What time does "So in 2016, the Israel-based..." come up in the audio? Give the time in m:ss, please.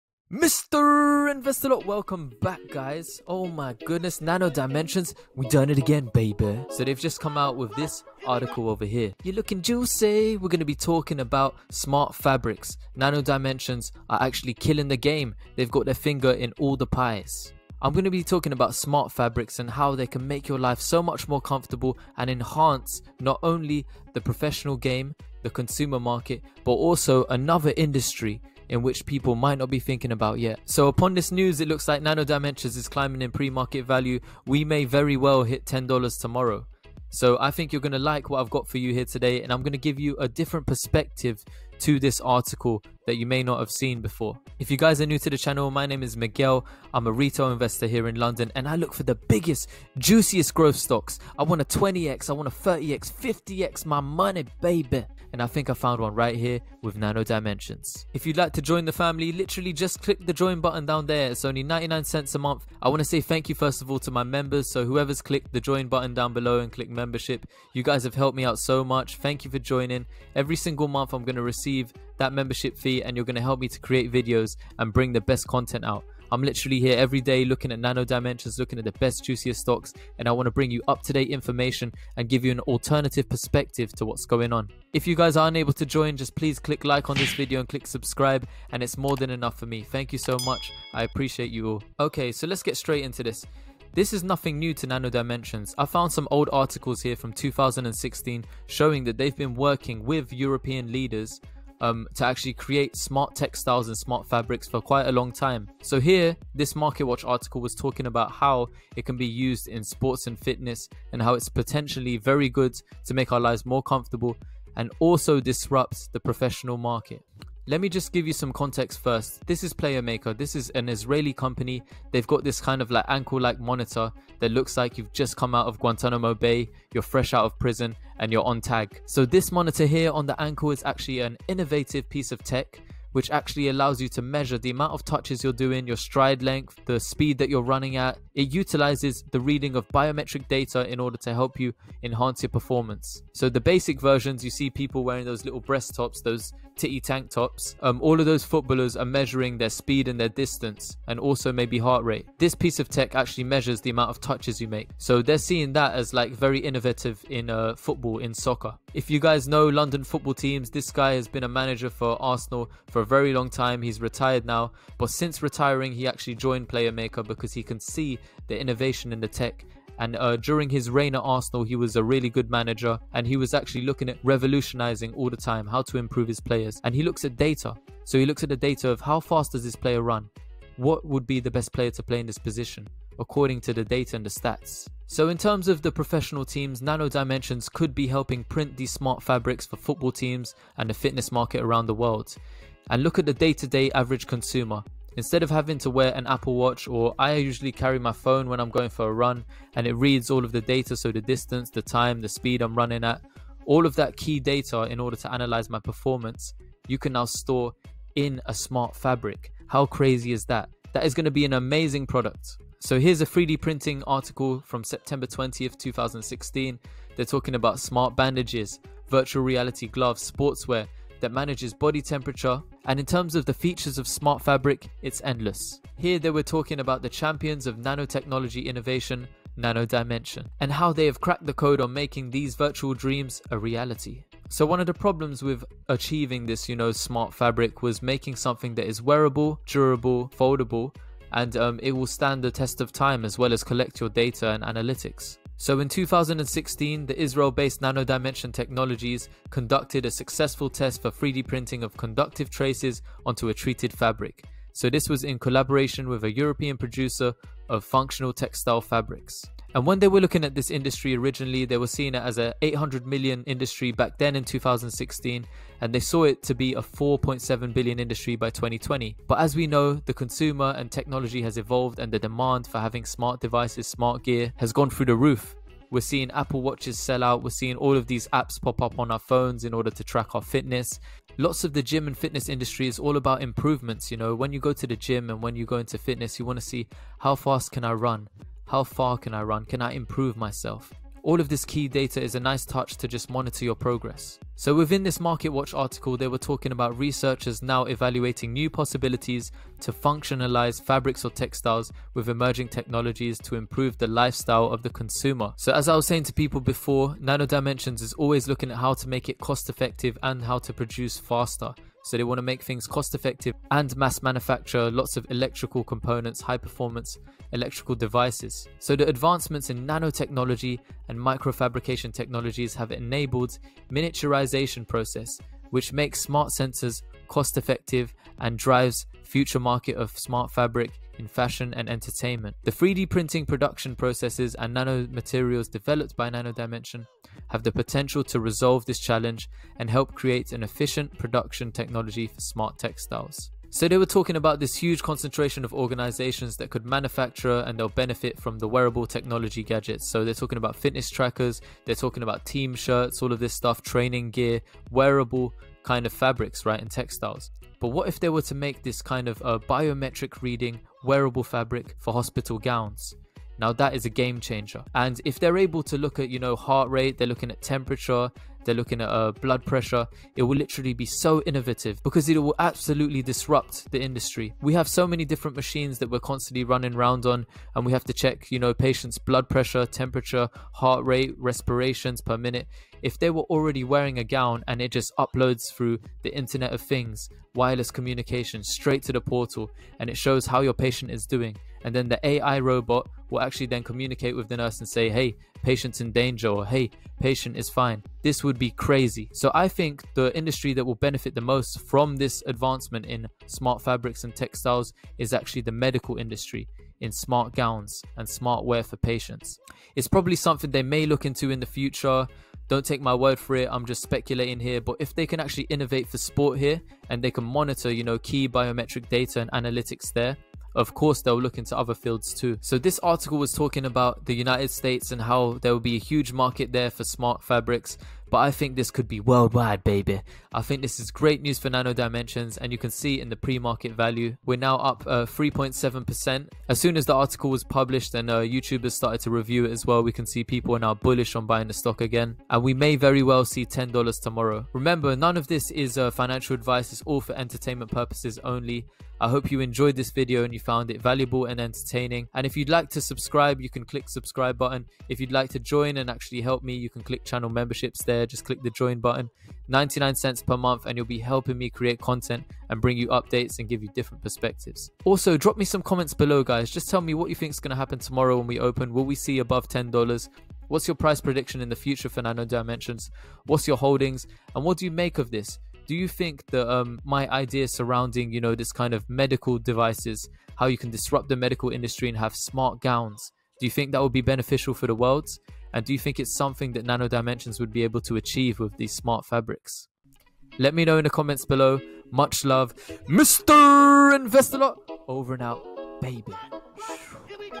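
4:05.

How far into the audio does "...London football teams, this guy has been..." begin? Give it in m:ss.
2:39.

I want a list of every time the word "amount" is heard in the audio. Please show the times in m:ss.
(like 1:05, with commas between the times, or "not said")
2:14, 2:33.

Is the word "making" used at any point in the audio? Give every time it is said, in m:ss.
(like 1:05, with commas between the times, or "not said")
3:51, 3:58.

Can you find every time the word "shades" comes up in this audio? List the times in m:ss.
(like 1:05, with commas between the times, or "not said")
not said.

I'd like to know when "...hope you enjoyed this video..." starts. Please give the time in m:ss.
7:29.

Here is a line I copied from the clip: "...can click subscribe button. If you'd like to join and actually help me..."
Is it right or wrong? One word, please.
right.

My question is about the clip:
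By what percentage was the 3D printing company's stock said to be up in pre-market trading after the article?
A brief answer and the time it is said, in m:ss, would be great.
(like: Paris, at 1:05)
3.7%, at 7:15.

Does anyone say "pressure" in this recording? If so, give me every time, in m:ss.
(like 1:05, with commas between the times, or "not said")
6:09, 6:19.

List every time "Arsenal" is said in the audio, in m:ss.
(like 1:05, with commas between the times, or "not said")
2:42, 2:51.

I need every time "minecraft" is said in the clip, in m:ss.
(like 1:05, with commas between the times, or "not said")
not said.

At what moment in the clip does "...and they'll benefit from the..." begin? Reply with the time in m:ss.
5:47.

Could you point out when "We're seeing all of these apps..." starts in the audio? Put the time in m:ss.
4:37.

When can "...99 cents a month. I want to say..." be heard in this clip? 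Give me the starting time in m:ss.
1:01.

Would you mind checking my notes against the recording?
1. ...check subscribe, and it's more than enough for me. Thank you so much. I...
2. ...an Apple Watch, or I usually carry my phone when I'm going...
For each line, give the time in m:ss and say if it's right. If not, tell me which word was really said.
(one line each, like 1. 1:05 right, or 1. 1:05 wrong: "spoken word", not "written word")
1. 1:27 wrong: "click", not "check"
2. 3:16 right.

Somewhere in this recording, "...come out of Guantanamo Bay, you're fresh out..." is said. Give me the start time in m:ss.
2:05.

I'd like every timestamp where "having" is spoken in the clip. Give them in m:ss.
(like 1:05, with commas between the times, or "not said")
3:15, 4:32.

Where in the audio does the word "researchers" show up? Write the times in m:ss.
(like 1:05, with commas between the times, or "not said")
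4:56.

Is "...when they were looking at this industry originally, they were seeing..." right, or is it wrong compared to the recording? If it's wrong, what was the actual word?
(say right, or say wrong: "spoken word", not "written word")
right.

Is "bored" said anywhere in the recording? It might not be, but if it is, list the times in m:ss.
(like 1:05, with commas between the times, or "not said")
not said.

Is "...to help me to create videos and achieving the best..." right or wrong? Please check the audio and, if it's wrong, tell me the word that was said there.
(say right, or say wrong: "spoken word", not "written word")
wrong: "bring", not "achieving".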